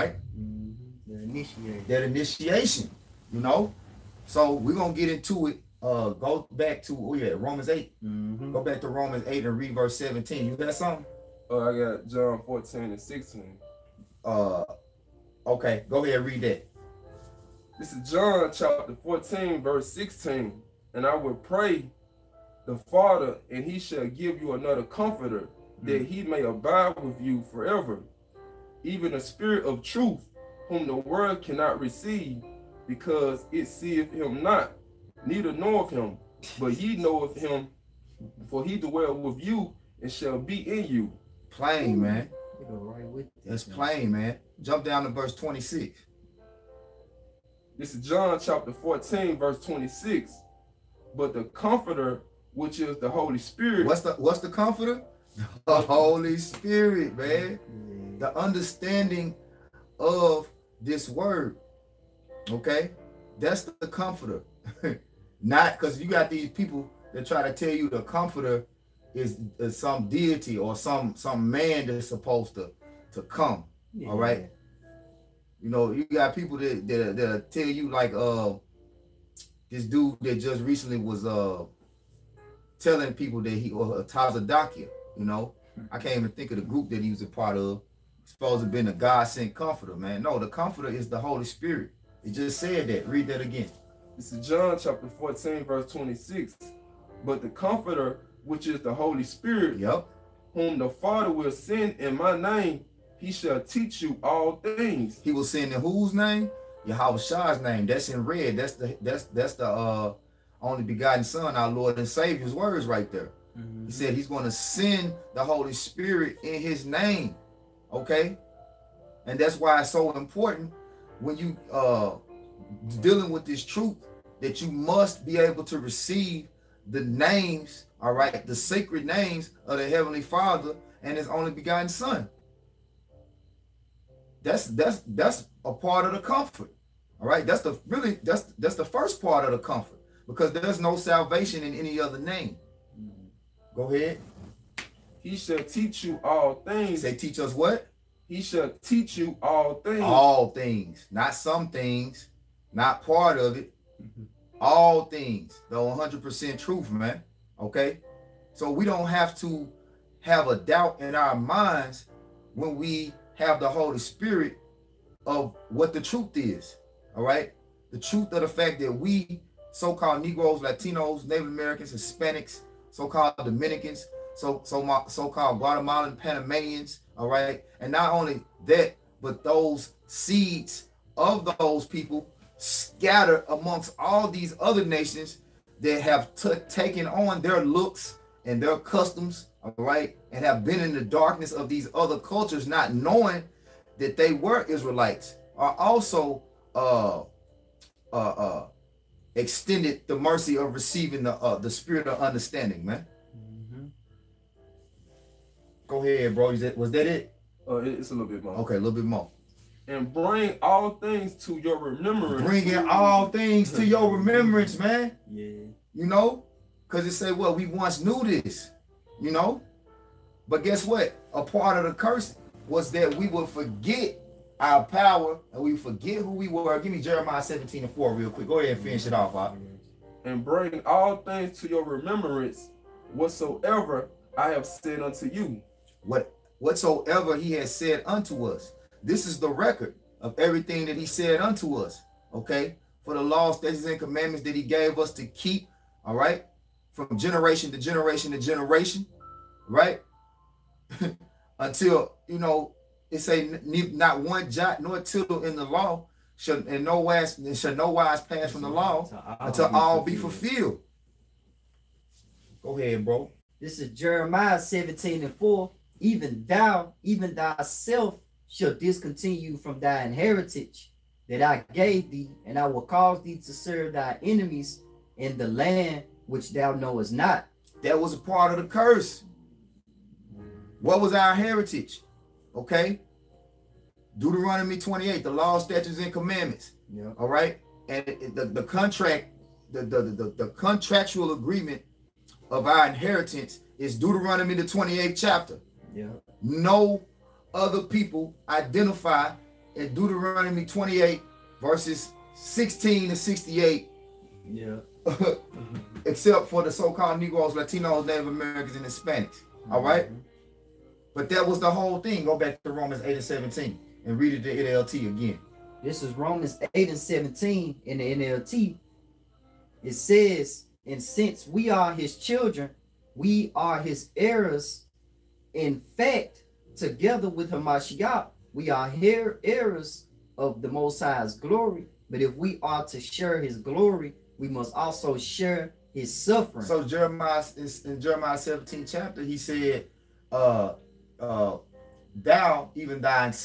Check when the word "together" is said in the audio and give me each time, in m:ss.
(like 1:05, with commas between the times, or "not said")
5:26.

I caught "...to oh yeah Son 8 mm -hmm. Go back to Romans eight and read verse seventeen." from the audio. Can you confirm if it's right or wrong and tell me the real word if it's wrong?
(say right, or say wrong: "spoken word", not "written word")
wrong: "Romans", not "Son".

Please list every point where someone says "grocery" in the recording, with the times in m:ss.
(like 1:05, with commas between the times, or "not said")
not said.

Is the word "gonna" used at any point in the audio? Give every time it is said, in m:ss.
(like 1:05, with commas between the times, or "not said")
1:54.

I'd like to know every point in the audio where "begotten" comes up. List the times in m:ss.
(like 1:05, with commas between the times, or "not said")
1:50, 2:11.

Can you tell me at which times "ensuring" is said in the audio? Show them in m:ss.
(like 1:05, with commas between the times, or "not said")
not said.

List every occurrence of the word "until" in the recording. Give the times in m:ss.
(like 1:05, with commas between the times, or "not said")
4:11, 4:19.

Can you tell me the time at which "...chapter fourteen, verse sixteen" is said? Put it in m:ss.
0:18.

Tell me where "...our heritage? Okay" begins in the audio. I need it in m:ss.
4:41.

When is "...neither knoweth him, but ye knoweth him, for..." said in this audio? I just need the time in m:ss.
0:35.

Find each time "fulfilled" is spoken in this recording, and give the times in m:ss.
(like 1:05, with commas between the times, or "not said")
4:20.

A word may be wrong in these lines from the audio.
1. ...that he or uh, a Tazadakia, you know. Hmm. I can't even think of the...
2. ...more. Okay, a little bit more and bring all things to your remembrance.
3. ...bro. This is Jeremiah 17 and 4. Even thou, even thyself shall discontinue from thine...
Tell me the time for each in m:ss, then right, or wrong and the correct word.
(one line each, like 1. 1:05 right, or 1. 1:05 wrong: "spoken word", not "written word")
1. 1:23 right
2. 3:28 right
3. 4:23 right.